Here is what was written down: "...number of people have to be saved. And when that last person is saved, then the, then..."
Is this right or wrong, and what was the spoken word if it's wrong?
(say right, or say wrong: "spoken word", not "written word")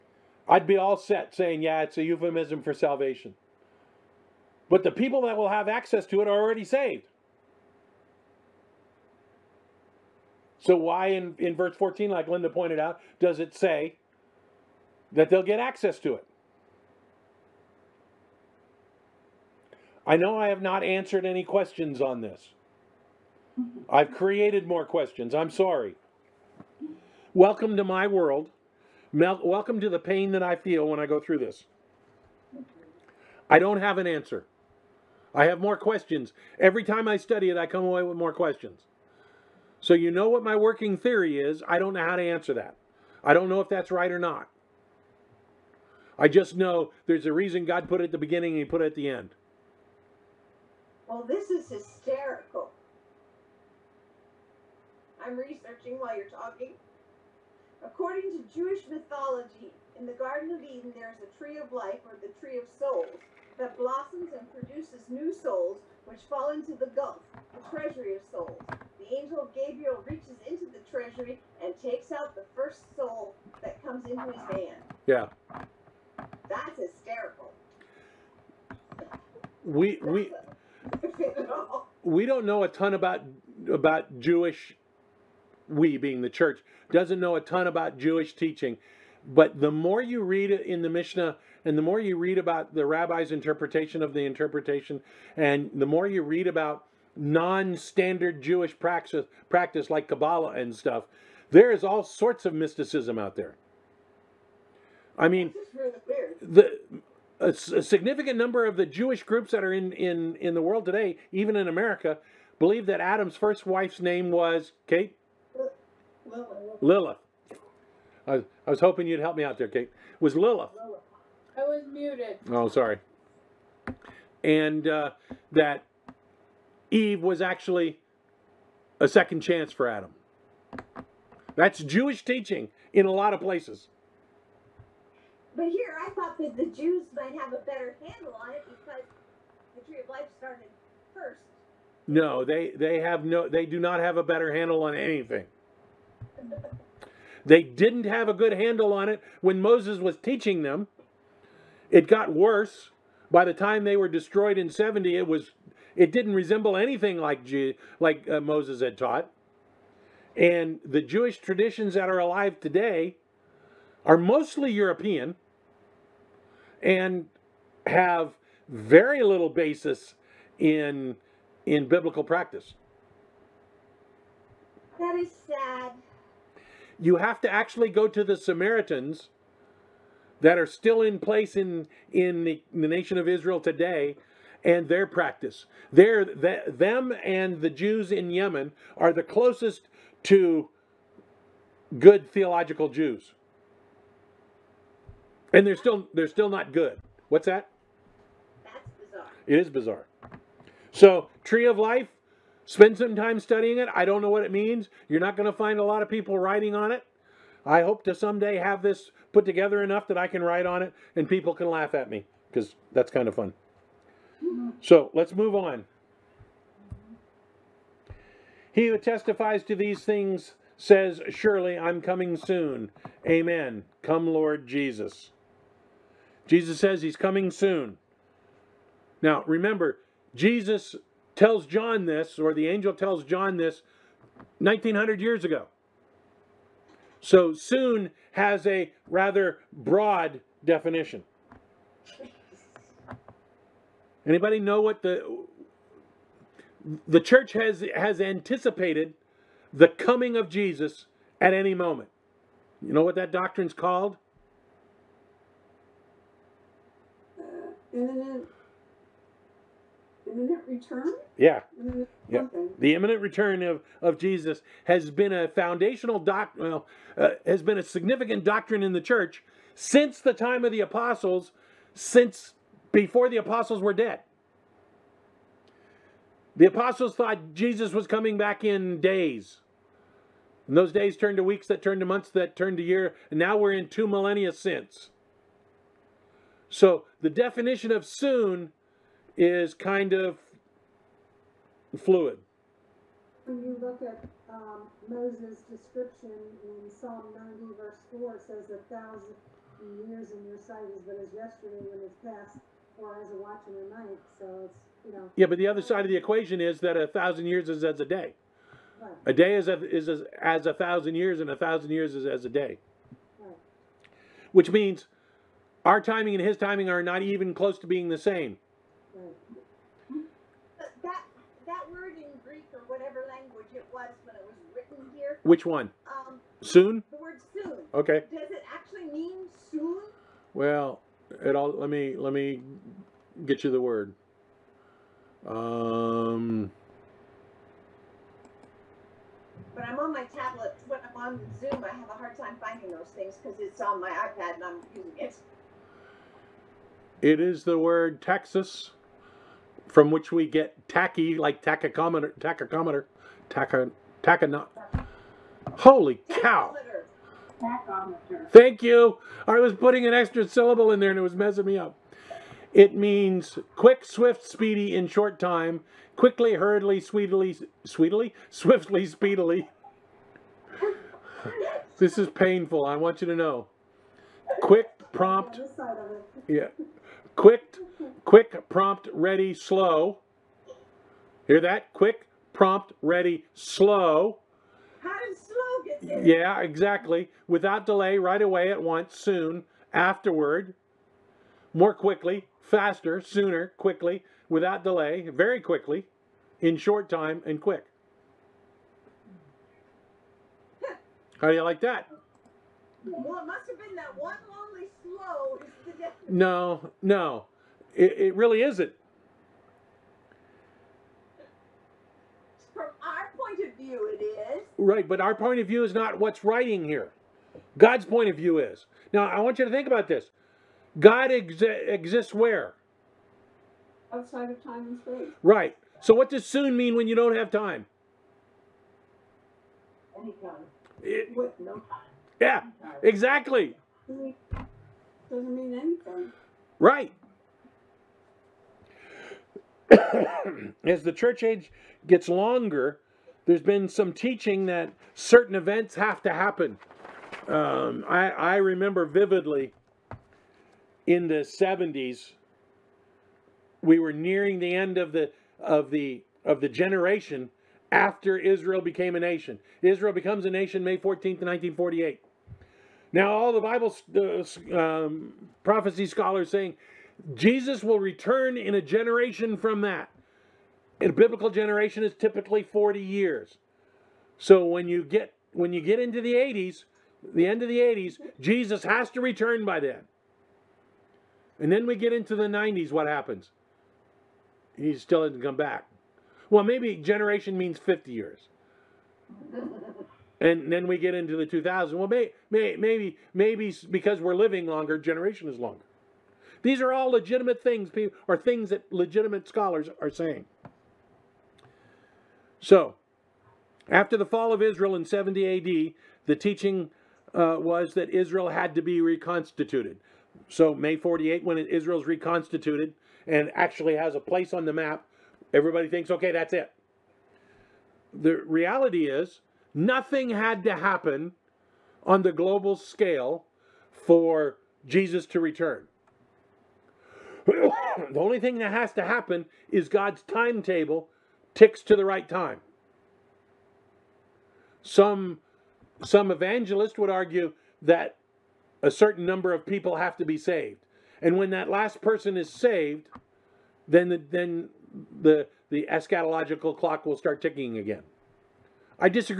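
right.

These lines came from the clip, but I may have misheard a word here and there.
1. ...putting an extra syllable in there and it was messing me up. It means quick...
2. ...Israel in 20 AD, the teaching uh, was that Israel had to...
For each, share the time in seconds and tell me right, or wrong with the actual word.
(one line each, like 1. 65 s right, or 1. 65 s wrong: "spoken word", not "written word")
1. 359 s right
2. 504 s wrong: "70", not "20".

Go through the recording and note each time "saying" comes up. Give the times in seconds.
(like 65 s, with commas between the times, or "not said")
1 s, 466 s, 500 s.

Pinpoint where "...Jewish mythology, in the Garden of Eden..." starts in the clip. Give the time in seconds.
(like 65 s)
58 s.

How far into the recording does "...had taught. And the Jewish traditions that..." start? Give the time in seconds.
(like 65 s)
158 s.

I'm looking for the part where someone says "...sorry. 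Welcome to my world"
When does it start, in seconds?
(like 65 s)
25 s.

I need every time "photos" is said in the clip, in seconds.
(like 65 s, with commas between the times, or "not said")
not said.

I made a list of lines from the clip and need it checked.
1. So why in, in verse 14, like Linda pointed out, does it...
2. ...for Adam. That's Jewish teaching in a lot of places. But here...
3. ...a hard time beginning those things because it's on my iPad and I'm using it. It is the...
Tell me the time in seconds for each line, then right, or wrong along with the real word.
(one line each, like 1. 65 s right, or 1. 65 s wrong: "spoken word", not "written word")
1. 10 s right
2. 129 s right
3. 342 s wrong: "finding", not "beginning".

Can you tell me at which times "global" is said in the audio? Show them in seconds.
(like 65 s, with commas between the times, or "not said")
522 s.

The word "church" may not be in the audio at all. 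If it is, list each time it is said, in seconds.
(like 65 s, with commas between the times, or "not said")
86 s, 247 s, 269 s, 441 s.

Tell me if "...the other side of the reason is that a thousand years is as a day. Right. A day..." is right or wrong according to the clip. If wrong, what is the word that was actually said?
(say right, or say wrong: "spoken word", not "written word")
wrong: "equation", not "reason".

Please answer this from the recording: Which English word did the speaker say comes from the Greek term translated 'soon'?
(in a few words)
Tacky.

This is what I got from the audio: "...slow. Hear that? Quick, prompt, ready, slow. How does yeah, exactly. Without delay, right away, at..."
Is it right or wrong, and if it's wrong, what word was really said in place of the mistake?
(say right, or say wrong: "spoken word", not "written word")
right.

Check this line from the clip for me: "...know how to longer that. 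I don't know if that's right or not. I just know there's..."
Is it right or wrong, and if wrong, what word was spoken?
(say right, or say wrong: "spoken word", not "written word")
wrong: "answer", not "longer".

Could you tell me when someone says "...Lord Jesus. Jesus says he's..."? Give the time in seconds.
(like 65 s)
224 s.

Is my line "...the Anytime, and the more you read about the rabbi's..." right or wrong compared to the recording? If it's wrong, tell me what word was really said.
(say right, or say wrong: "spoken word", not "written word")
wrong: "Mishnah", not "Anytime".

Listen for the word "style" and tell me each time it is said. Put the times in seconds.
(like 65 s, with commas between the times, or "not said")
not said.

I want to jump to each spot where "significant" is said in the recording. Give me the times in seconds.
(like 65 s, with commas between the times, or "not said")
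107 s, 267 s.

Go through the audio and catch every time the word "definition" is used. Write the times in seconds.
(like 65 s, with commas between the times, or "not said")
240 s, 287 s.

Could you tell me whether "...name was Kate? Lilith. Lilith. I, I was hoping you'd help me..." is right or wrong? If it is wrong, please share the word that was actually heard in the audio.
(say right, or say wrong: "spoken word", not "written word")
right.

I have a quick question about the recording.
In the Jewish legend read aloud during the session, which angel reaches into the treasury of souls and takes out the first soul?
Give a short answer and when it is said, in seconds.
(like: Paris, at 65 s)
Gabriel, at 69 s.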